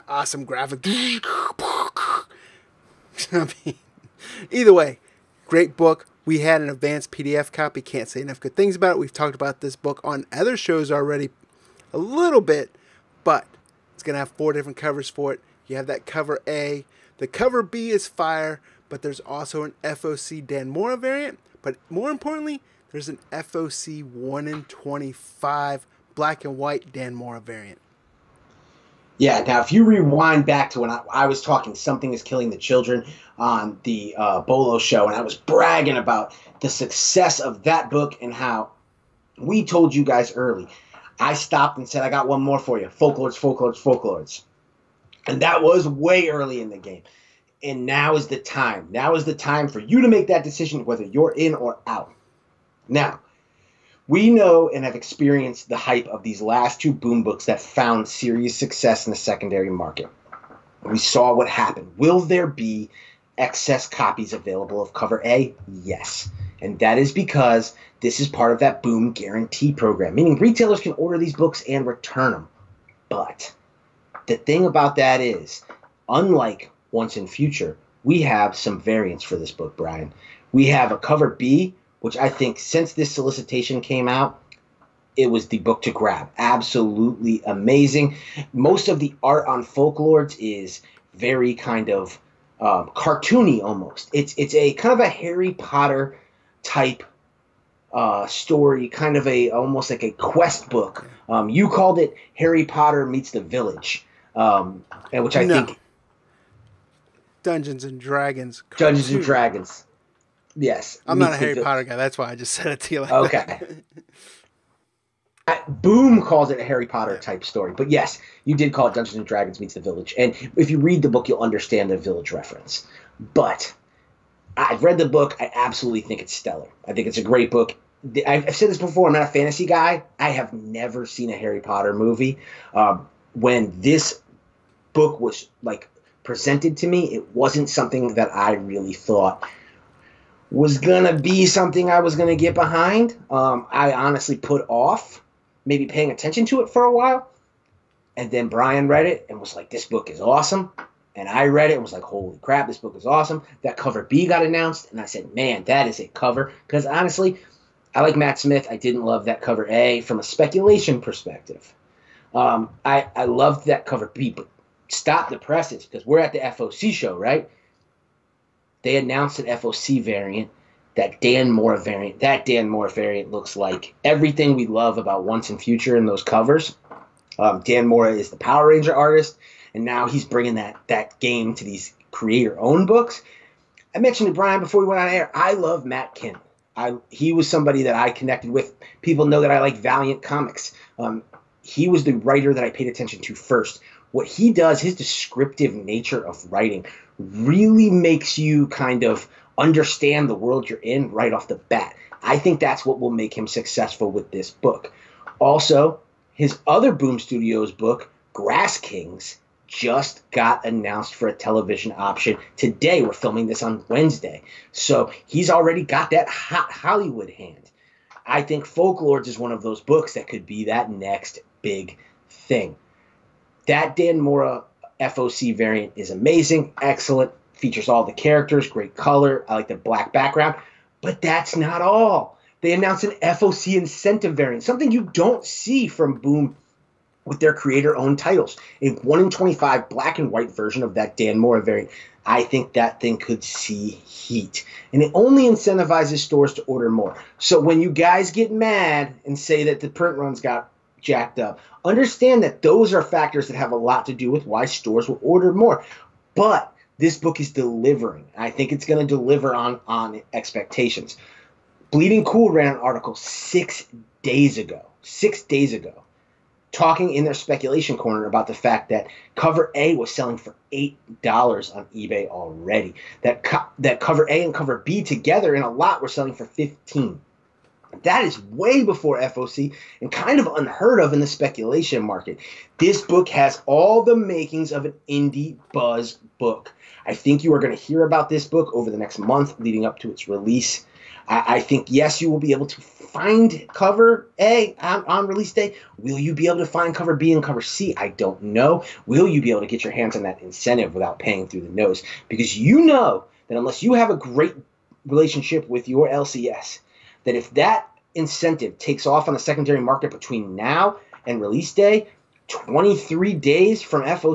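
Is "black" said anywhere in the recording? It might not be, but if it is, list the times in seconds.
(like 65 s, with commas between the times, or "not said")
26 s, 229 s, 239 s.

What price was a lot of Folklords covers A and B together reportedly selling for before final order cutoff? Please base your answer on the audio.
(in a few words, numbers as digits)
$15.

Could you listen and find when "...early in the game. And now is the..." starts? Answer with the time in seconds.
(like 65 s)
46 s.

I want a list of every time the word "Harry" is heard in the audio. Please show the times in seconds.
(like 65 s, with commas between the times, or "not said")
95 s, 102 s, 111 s, 116 s, 131 s.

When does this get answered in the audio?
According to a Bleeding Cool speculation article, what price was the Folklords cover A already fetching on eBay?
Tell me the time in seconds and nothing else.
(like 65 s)
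270 s.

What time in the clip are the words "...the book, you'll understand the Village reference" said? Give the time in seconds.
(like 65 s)
121 s.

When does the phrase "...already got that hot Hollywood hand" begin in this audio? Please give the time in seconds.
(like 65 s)
215 s.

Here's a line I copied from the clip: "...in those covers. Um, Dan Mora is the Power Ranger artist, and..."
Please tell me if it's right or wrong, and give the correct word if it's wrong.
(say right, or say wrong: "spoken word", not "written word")
right.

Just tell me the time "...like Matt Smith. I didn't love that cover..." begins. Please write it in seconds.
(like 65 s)
158 s.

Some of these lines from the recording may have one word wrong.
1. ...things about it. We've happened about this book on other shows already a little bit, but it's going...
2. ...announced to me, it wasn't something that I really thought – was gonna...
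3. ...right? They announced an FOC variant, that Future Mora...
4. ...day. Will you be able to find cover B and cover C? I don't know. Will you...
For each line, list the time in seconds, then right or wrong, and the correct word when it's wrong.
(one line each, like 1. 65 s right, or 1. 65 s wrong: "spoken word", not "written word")
1. 8 s wrong: "talked", not "happened"
2. 136 s wrong: "presented", not "announced"
3. 167 s wrong: "Dan", not "Future"
4. 295 s right.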